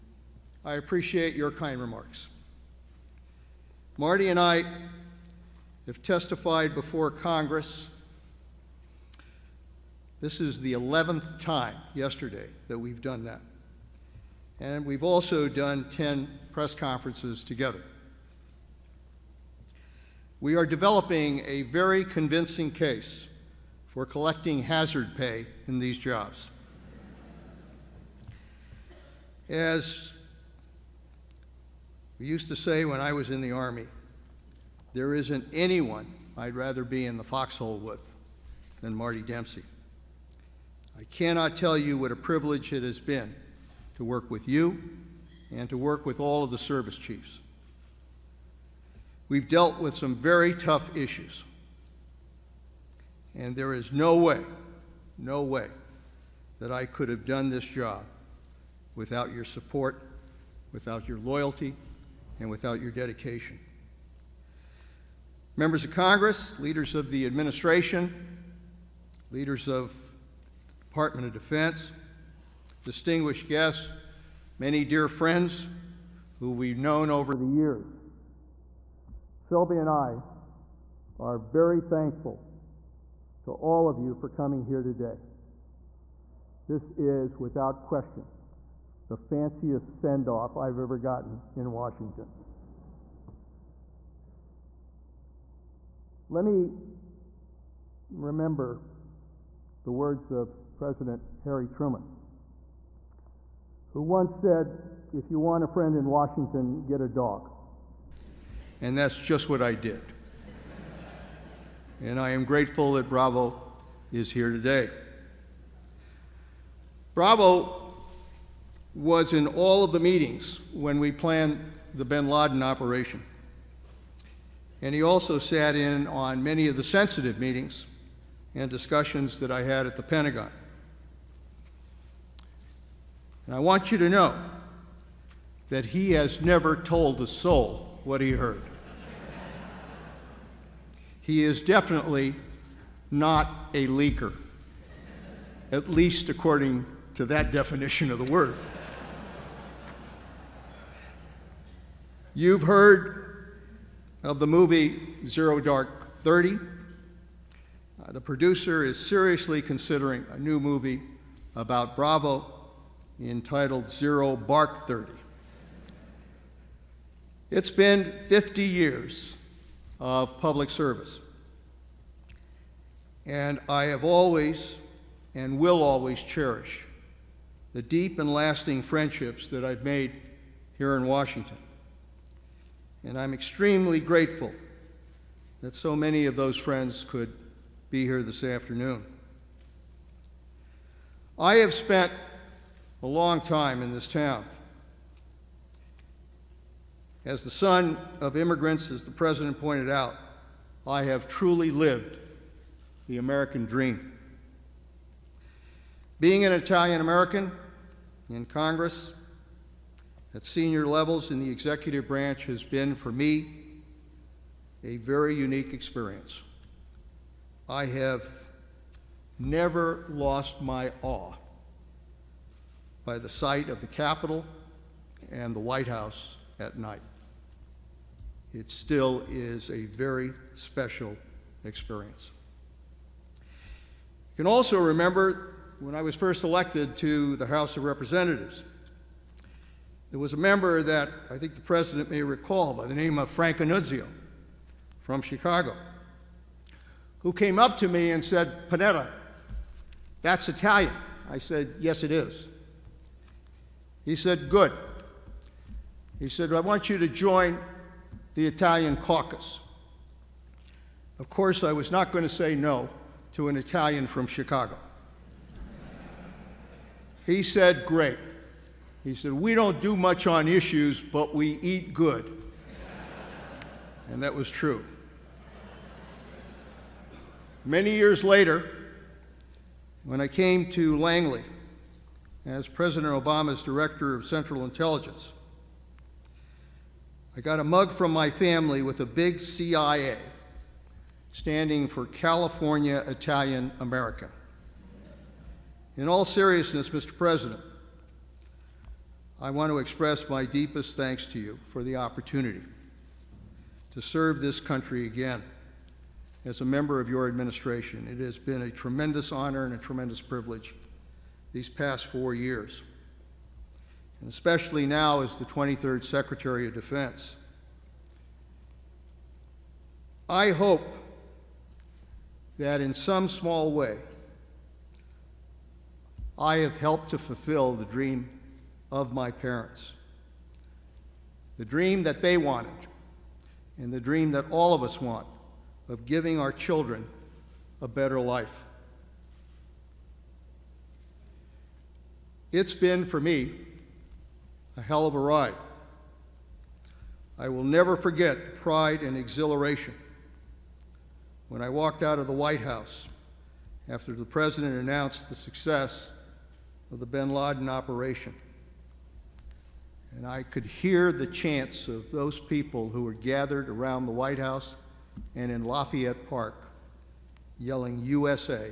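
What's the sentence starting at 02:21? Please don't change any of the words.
he is definitely not a leaker, at least according to that definition of the word.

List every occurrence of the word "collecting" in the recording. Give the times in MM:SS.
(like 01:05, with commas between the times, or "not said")
00:24.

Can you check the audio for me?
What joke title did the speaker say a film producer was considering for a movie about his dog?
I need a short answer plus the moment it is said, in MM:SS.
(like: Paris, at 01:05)
Zero Bark 30, at 02:43.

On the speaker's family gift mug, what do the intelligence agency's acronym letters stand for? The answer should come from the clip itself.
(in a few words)
California Italian American.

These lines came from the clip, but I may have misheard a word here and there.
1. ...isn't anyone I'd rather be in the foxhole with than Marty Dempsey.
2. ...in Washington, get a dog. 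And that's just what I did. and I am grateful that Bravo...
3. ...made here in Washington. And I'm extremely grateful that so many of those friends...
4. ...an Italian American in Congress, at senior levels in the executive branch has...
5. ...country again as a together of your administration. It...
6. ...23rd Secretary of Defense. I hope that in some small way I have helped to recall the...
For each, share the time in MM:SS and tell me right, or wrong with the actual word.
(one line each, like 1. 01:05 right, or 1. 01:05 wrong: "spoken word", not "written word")
1. 00:35 right
2. 01:45 right
3. 02:59 right
4. 03:26 right
5. 05:04 wrong: "member", not "together"
6. 05:15 wrong: "fulfill", not "recall".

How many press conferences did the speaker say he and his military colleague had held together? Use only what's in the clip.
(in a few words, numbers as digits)
10.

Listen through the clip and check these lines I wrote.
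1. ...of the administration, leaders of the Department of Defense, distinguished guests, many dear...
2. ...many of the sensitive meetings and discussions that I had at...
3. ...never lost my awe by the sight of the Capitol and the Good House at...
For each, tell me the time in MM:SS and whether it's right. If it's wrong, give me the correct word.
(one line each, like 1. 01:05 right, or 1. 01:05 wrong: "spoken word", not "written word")
1. 01:06 right
2. 02:06 right
3. 03:39 wrong: "White", not "Good".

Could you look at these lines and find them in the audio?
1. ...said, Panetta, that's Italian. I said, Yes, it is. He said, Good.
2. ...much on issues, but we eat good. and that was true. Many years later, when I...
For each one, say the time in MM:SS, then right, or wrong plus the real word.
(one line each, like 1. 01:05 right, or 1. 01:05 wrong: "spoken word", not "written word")
1. 04:08 right
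2. 04:29 right.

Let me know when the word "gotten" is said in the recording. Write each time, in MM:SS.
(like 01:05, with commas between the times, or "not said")
01:30.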